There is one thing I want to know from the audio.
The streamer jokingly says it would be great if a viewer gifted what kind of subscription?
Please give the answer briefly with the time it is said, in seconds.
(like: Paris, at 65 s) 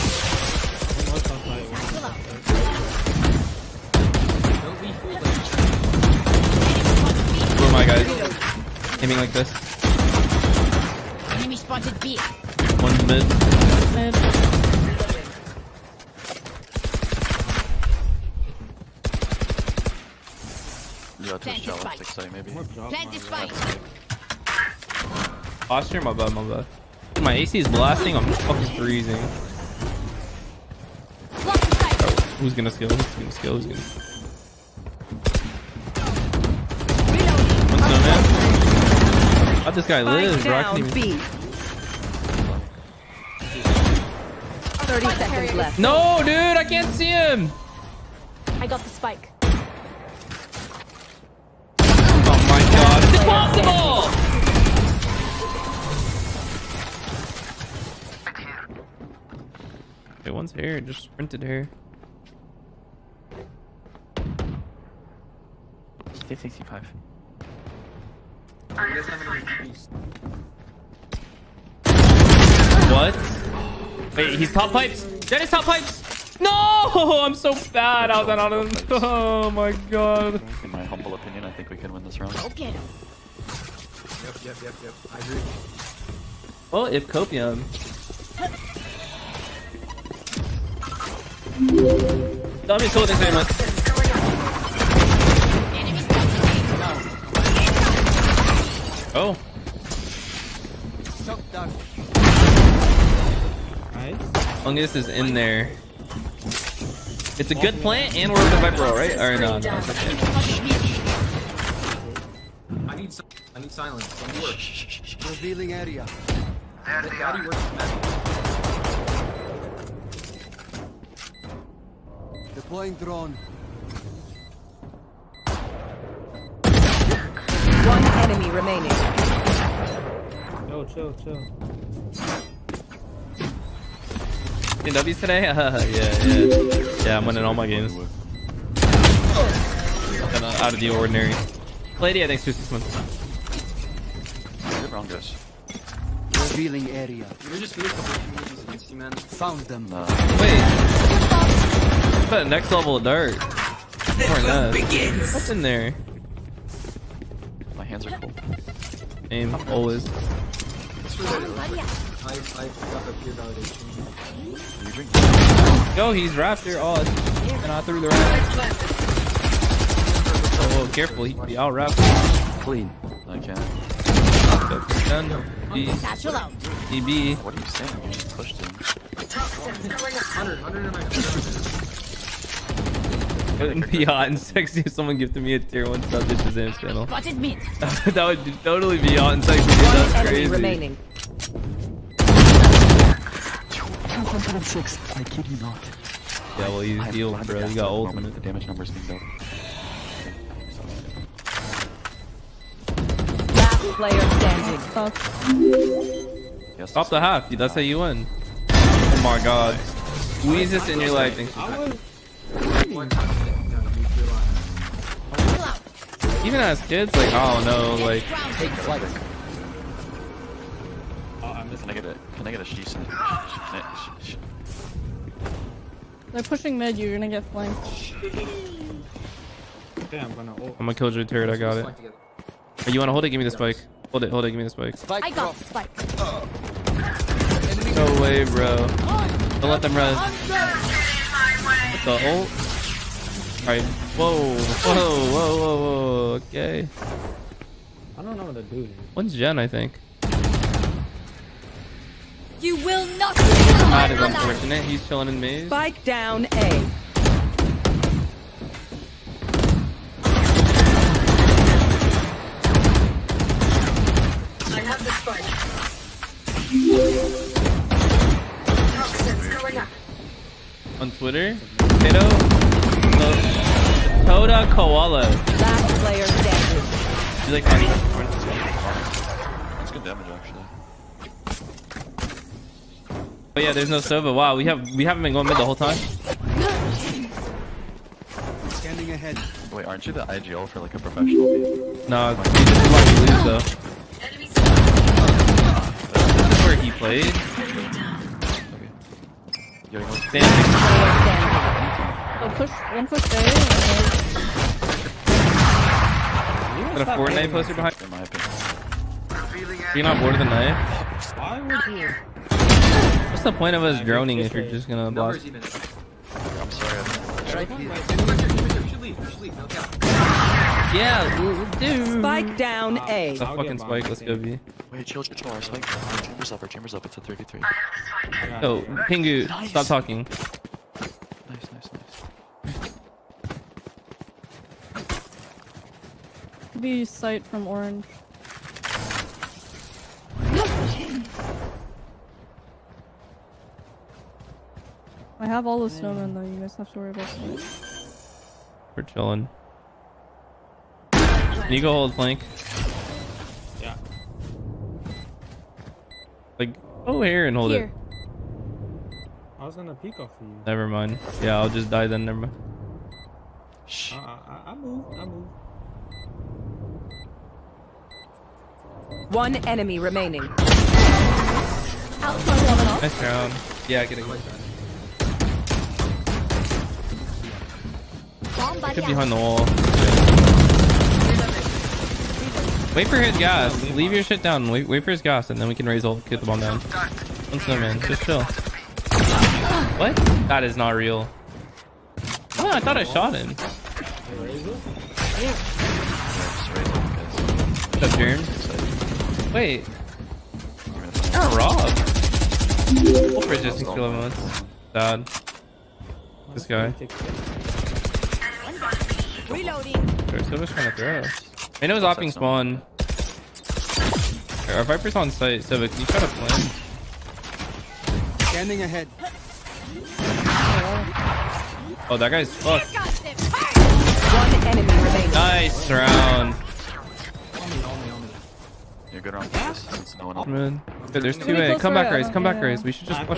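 tier one sub, at 185 s.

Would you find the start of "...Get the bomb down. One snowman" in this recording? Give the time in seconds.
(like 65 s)
386 s.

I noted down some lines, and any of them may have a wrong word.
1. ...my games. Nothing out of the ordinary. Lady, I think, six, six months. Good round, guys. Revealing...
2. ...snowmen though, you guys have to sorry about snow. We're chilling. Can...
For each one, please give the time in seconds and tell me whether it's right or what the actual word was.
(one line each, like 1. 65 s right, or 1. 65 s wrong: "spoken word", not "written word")
1. 137 s wrong: "two", not "six"
2. 345 s wrong: "worry", not "sorry".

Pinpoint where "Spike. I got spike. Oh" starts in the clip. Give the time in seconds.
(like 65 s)
234 s.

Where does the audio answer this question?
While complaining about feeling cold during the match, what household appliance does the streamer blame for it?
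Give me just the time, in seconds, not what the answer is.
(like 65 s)
27 s.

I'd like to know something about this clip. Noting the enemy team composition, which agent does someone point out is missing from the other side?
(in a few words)
Sova.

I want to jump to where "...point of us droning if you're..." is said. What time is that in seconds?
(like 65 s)
313 s.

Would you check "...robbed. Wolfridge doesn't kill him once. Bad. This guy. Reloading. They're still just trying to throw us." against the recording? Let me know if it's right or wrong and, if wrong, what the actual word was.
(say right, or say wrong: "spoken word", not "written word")
right.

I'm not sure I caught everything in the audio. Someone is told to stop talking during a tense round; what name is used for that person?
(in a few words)
Pingu.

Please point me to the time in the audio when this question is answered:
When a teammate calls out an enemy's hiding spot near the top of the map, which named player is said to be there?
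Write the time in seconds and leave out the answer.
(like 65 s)
75 s.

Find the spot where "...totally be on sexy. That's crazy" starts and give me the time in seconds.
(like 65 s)
188 s.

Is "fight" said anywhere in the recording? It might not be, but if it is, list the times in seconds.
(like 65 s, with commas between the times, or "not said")
23 s, 277 s.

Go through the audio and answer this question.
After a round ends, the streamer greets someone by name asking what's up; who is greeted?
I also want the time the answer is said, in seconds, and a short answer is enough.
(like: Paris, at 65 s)
Jerm, at 393 s.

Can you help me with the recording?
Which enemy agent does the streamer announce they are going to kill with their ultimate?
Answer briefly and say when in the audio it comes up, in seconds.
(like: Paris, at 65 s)
Jupiter, at 230 s.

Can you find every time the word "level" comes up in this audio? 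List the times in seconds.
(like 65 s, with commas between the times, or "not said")
152 s.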